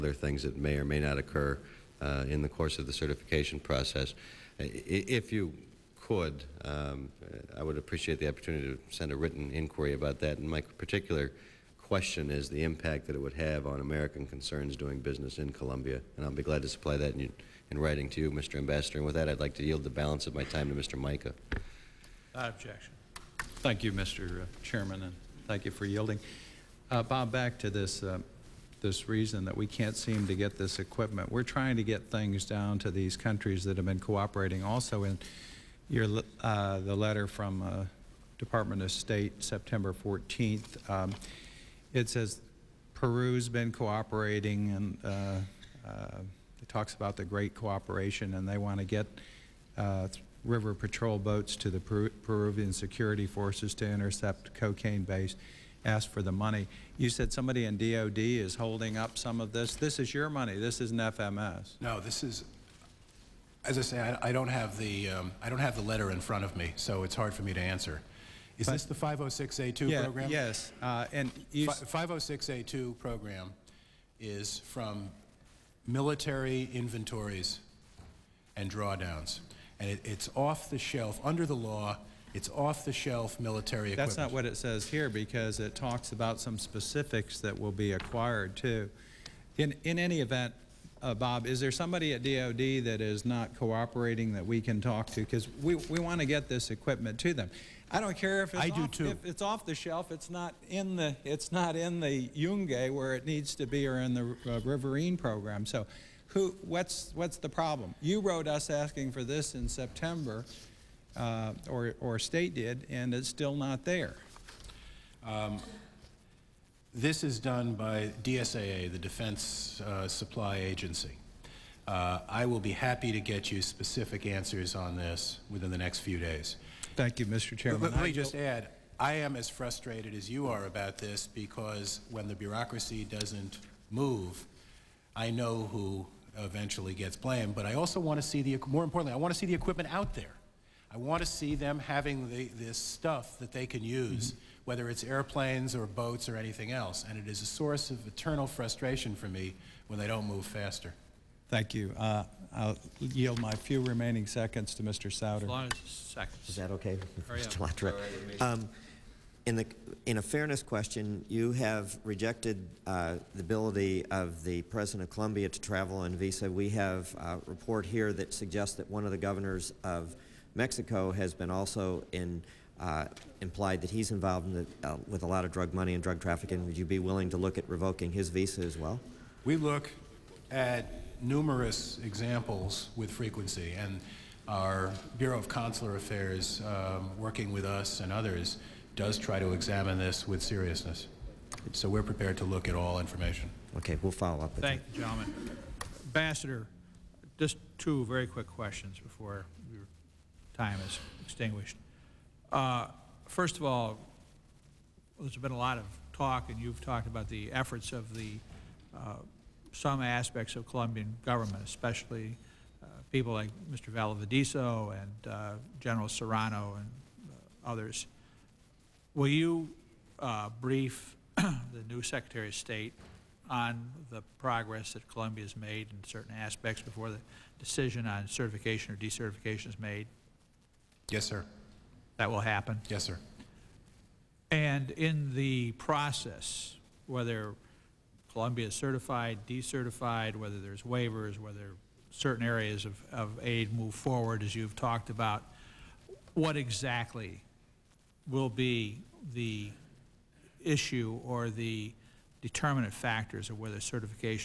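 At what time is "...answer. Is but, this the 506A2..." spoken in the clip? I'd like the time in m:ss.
1:07.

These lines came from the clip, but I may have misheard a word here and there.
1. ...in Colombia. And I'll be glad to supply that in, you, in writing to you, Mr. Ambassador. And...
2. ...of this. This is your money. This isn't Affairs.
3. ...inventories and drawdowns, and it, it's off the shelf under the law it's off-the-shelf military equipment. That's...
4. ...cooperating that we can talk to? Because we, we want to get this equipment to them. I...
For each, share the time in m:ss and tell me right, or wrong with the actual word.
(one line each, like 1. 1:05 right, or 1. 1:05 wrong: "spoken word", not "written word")
1. 0:15 right
2. 0:59 wrong: "FMS", not "Affairs"
3. 1:16 right
4. 1:33 right.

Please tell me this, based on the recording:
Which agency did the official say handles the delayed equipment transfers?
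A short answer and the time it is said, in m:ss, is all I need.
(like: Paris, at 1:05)
DSAA, at 1:58.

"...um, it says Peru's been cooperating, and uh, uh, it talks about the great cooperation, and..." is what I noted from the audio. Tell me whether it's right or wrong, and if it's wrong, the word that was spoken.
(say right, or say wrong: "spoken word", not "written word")
right.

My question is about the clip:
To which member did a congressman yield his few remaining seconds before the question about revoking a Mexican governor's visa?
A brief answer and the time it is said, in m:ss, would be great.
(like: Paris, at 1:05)
Mr. Souder, at 2:34.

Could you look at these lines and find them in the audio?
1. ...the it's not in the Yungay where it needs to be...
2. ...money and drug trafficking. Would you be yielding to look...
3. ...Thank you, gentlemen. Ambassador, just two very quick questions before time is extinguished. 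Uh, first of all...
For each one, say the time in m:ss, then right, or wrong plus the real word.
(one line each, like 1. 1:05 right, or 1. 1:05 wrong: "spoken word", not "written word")
1. 1:40 right
2. 2:55 wrong: "willing", not "yielding"
3. 3:14 right.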